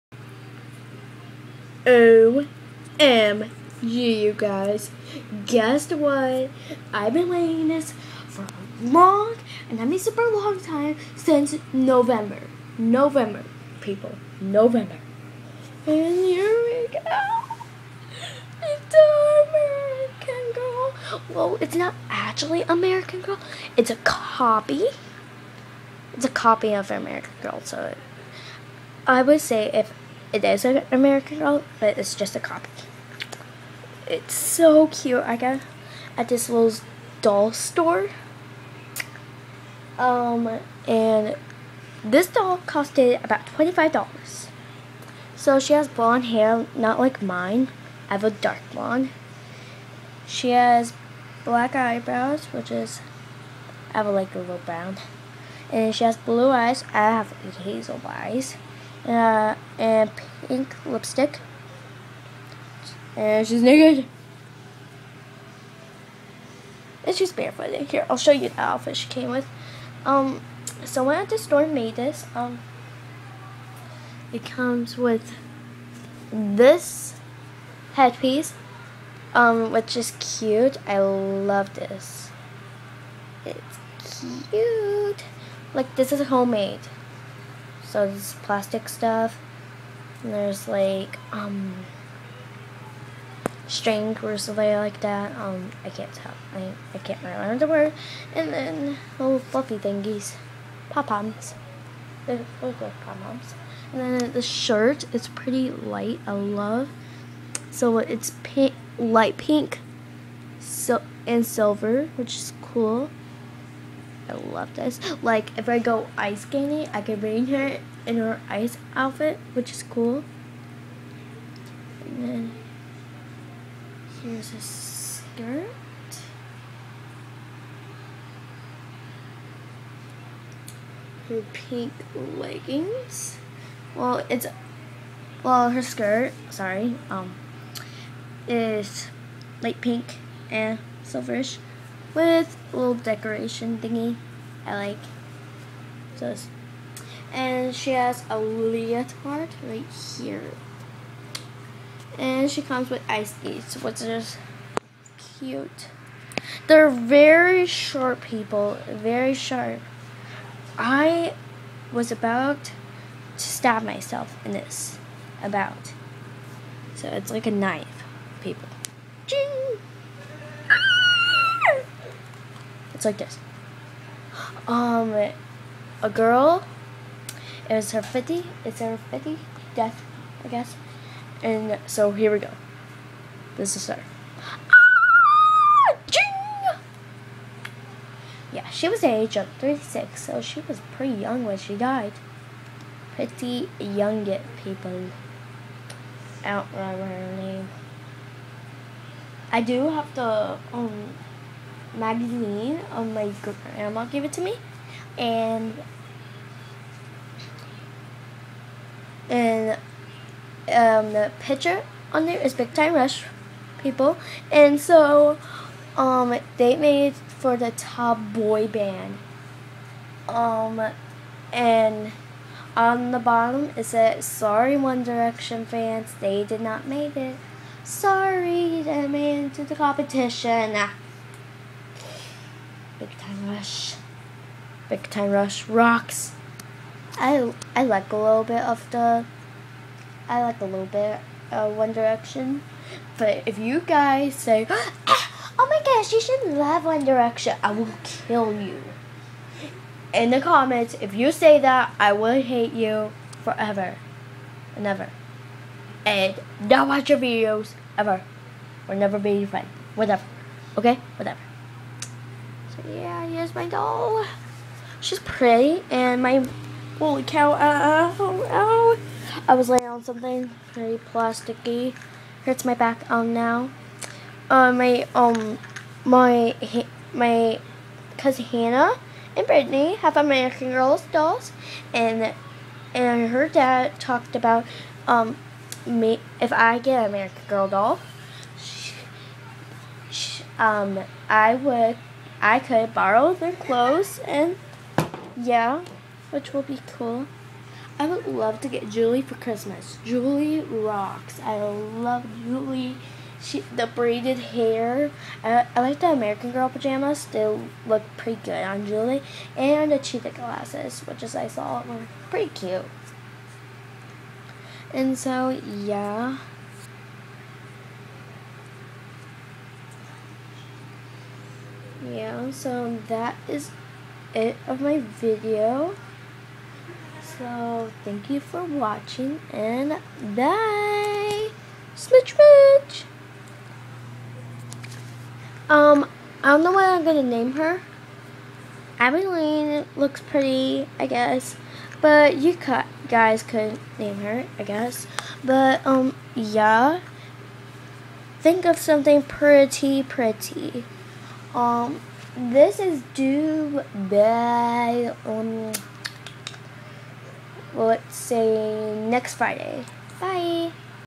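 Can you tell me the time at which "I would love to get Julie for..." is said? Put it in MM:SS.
04:57.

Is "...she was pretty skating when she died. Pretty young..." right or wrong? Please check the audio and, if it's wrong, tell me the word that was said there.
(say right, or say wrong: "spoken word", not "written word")
wrong: "young", not "skating".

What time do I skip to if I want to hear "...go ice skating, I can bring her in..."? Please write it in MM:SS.
01:55.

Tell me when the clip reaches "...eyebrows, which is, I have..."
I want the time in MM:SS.
00:51.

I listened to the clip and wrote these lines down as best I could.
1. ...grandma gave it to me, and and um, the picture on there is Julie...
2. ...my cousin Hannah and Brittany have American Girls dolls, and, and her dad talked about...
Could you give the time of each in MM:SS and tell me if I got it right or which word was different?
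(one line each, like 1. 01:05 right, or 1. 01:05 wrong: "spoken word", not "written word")
1. 03:23 wrong: "Big", not "Julie"
2. 04:37 right.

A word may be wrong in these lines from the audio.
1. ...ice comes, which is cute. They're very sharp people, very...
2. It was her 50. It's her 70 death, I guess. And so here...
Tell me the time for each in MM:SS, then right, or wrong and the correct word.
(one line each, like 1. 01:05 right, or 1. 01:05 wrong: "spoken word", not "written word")
1. 02:33 wrong: "skates", not "comes"
2. 02:57 wrong: "50", not "70".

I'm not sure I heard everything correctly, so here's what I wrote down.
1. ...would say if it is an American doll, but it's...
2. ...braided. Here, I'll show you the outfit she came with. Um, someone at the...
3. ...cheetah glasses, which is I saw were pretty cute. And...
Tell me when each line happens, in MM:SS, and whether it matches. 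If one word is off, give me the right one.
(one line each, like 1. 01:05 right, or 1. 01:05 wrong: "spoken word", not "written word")
1. 00:29 right
2. 01:07 wrong: "barefooted", not "braided"
3. 05:09 right.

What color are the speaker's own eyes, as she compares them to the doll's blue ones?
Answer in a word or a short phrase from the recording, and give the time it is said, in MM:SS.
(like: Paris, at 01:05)
Hazel, at 00:57.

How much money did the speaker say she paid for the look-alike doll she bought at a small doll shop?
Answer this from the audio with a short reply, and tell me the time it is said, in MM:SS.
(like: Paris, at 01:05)
$25, at 00:43.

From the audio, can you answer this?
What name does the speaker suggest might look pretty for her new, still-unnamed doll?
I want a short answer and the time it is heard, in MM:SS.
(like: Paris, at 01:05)
Abilene, at 05:38.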